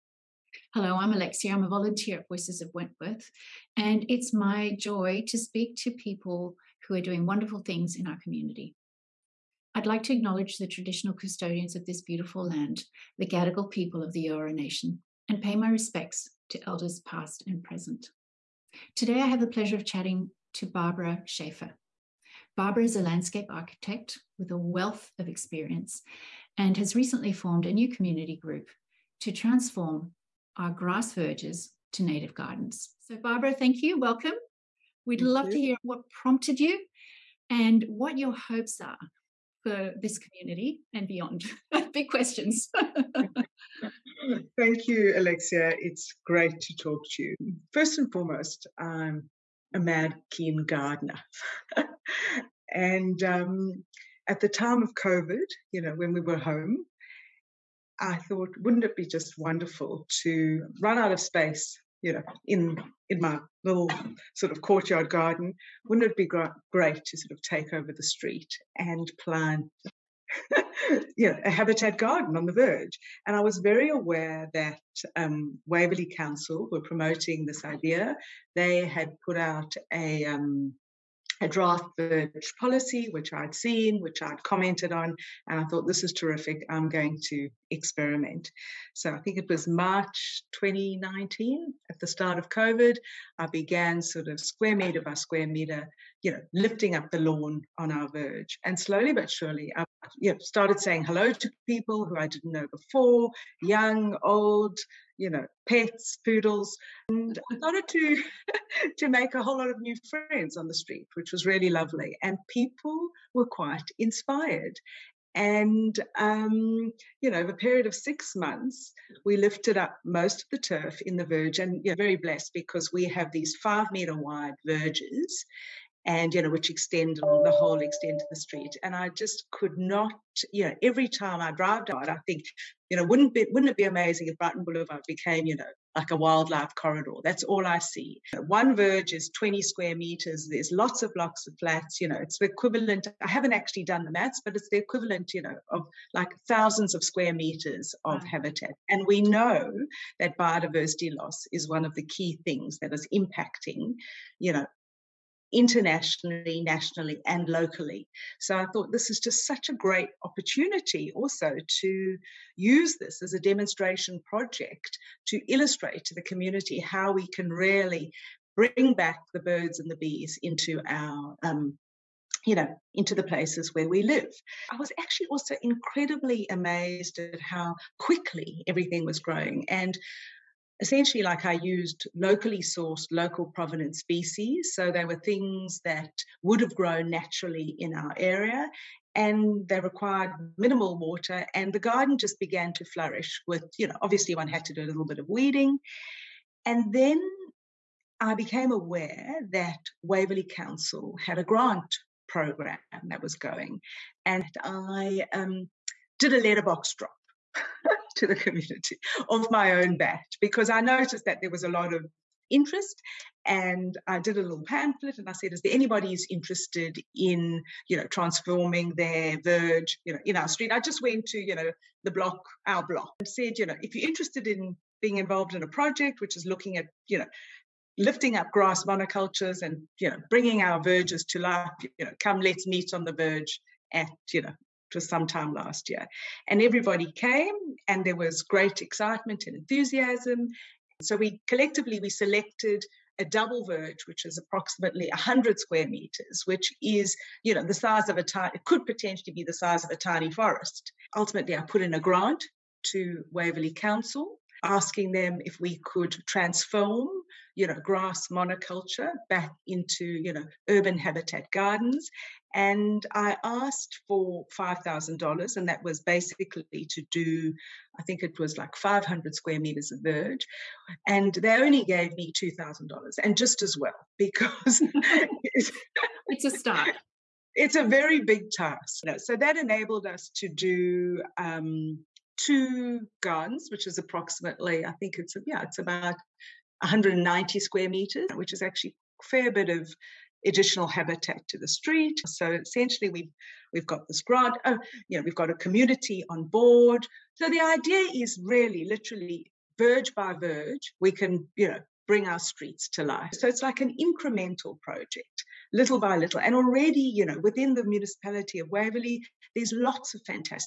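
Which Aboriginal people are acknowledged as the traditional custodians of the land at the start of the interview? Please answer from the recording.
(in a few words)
Gadigal.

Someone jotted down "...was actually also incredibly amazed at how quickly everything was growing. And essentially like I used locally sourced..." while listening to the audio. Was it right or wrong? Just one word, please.
right.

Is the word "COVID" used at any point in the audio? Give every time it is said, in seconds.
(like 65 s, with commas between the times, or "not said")
54 s, 92 s.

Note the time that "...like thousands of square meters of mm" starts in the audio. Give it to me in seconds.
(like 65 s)
146 s.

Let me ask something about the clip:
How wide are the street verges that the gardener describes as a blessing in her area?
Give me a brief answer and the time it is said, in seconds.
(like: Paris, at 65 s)
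5 meters, at 123 s.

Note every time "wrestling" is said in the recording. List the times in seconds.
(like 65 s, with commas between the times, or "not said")
not said.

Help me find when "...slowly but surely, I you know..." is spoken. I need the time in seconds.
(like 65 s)
98 s.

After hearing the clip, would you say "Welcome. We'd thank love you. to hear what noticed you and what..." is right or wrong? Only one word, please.
wrong.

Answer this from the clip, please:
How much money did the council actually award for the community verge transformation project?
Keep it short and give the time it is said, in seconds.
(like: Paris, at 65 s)
$2,000, at 272 s.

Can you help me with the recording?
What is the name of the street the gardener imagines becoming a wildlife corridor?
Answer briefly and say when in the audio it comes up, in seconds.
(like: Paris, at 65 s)
Brighton Boulevard, at 134 s.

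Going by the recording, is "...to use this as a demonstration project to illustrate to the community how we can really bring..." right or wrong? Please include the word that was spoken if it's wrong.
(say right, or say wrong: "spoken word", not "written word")
right.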